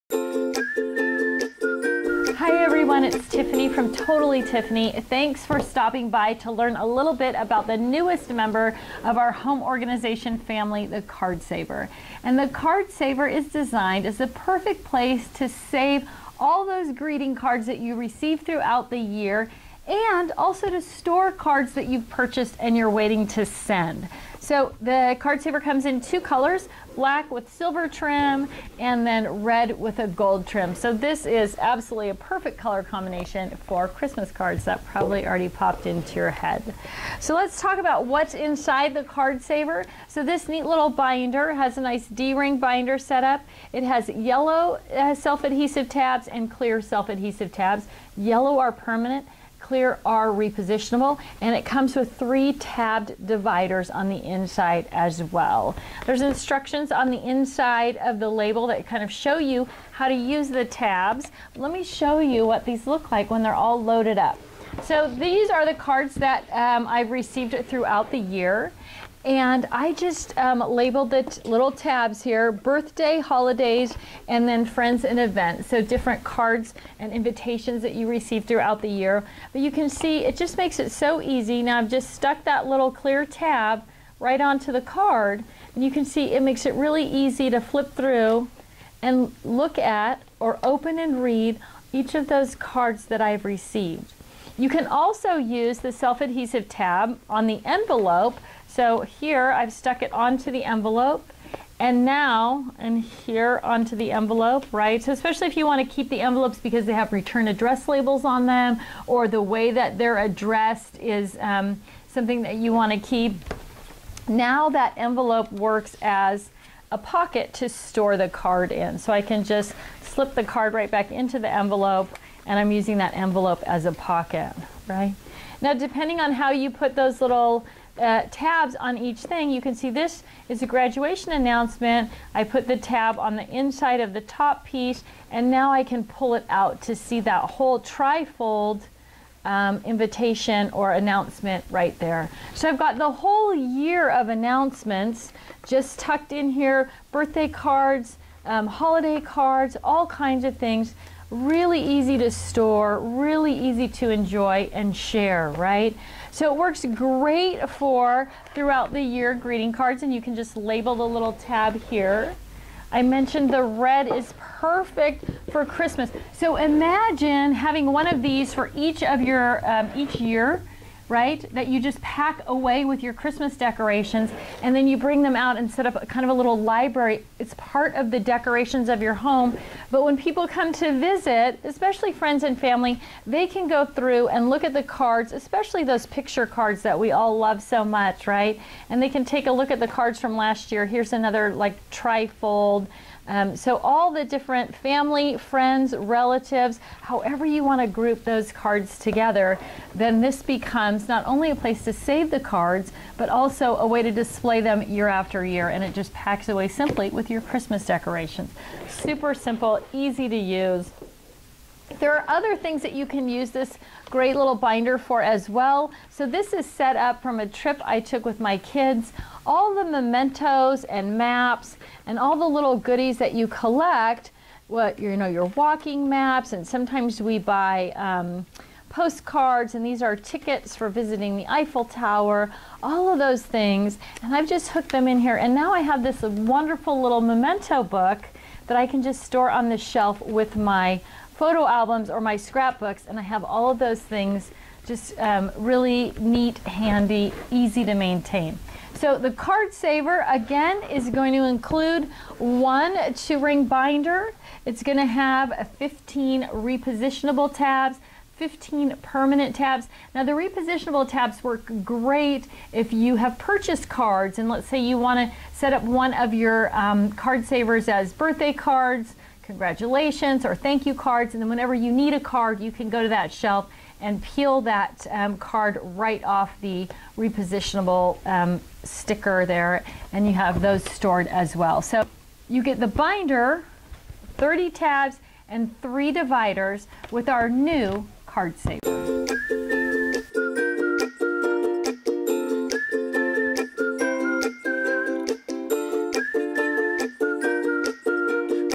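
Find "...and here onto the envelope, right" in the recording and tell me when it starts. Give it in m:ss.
1:42.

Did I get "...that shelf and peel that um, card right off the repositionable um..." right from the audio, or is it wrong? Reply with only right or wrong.
right.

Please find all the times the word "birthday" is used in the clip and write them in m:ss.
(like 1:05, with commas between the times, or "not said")
1:12, 2:27, 4:28.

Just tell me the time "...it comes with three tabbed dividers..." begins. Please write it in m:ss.
0:51.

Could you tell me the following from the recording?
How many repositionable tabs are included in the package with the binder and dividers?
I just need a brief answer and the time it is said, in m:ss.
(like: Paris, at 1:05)
15, at 4:15.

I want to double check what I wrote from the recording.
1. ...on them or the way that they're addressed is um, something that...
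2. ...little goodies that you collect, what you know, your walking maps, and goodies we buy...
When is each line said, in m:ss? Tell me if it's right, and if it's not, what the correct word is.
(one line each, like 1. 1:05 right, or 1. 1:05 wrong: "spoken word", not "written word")
1. 1:48 right
2. 3:42 wrong: "sometimes", not "goodies".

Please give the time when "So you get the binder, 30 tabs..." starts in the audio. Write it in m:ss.
4:41.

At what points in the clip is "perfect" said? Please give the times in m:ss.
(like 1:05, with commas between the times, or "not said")
0:14, 0:32, 2:44.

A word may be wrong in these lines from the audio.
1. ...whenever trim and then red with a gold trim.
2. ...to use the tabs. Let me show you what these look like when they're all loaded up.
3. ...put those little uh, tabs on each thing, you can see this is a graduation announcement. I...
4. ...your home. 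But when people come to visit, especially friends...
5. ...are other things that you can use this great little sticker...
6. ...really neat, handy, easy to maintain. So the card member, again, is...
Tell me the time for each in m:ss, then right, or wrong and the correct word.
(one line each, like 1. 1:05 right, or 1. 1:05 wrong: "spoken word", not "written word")
1. 0:27 wrong: "silver", not "whenever"
2. 1:00 right
3. 2:06 right
4. 2:59 right
5. 3:32 wrong: "binder", not "sticker"
6. 4:05 wrong: "saver", not "member".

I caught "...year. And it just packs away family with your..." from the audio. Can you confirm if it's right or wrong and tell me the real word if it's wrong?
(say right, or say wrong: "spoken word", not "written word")
wrong: "simply", not "family".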